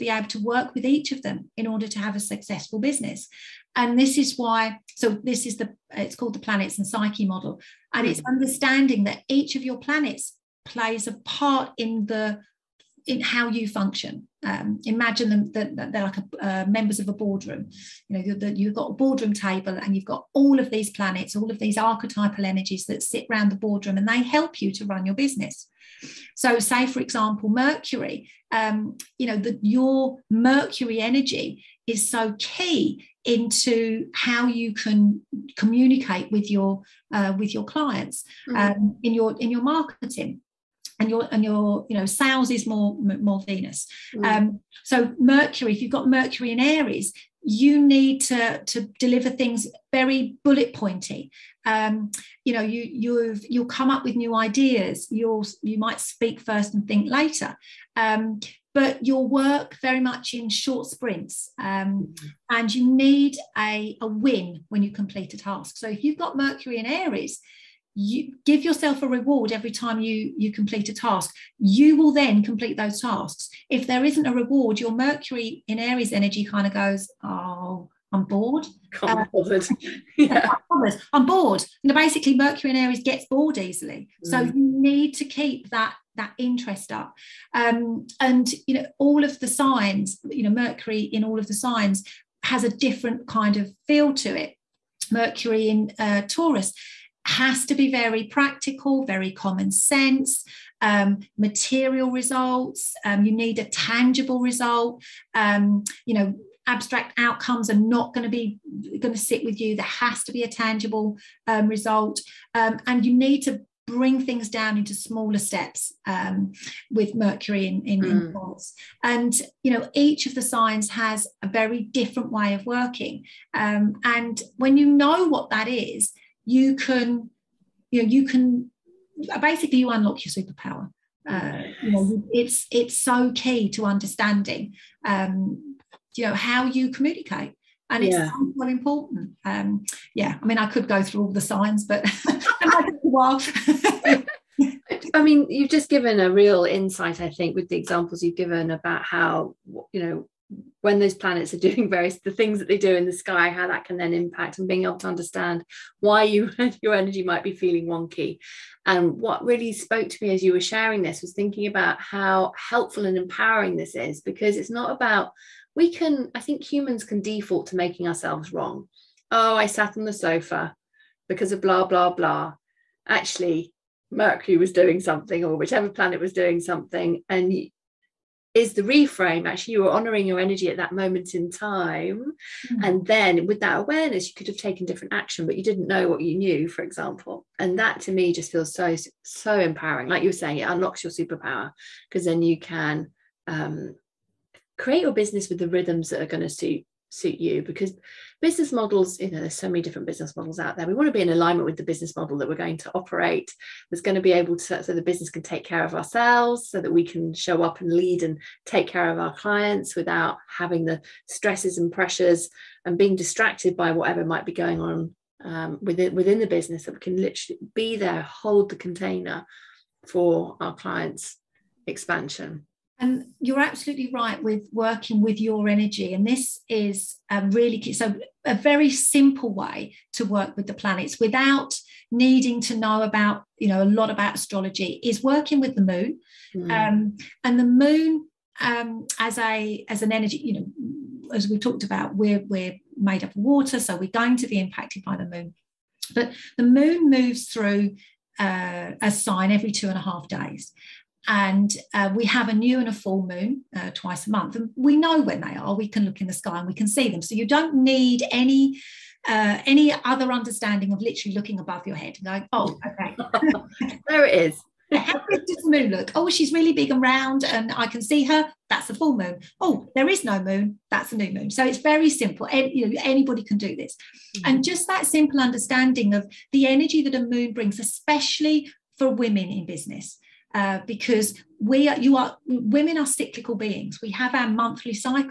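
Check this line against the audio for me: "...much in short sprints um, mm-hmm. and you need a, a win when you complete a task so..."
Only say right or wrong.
right.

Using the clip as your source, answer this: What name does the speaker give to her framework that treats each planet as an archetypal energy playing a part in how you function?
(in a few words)
planets and psyche model.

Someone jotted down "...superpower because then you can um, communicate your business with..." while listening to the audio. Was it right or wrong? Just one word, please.
wrong.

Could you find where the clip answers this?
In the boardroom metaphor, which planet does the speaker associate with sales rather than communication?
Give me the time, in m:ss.
0:43.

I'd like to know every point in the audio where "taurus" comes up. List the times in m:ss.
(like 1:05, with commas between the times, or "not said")
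1:36.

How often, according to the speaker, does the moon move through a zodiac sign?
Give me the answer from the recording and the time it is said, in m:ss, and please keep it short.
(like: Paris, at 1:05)
every 2.5 days, at 4:09.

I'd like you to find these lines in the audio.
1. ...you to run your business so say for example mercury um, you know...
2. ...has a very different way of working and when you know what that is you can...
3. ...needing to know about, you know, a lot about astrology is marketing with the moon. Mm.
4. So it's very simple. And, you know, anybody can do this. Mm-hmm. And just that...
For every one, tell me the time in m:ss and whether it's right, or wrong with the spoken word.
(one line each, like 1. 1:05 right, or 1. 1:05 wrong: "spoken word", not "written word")
1. 0:24 right
2. 2:00 right
3. 3:52 wrong: "working", not "marketing"
4. 4:31 right.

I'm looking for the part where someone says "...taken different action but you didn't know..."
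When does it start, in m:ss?
3:04.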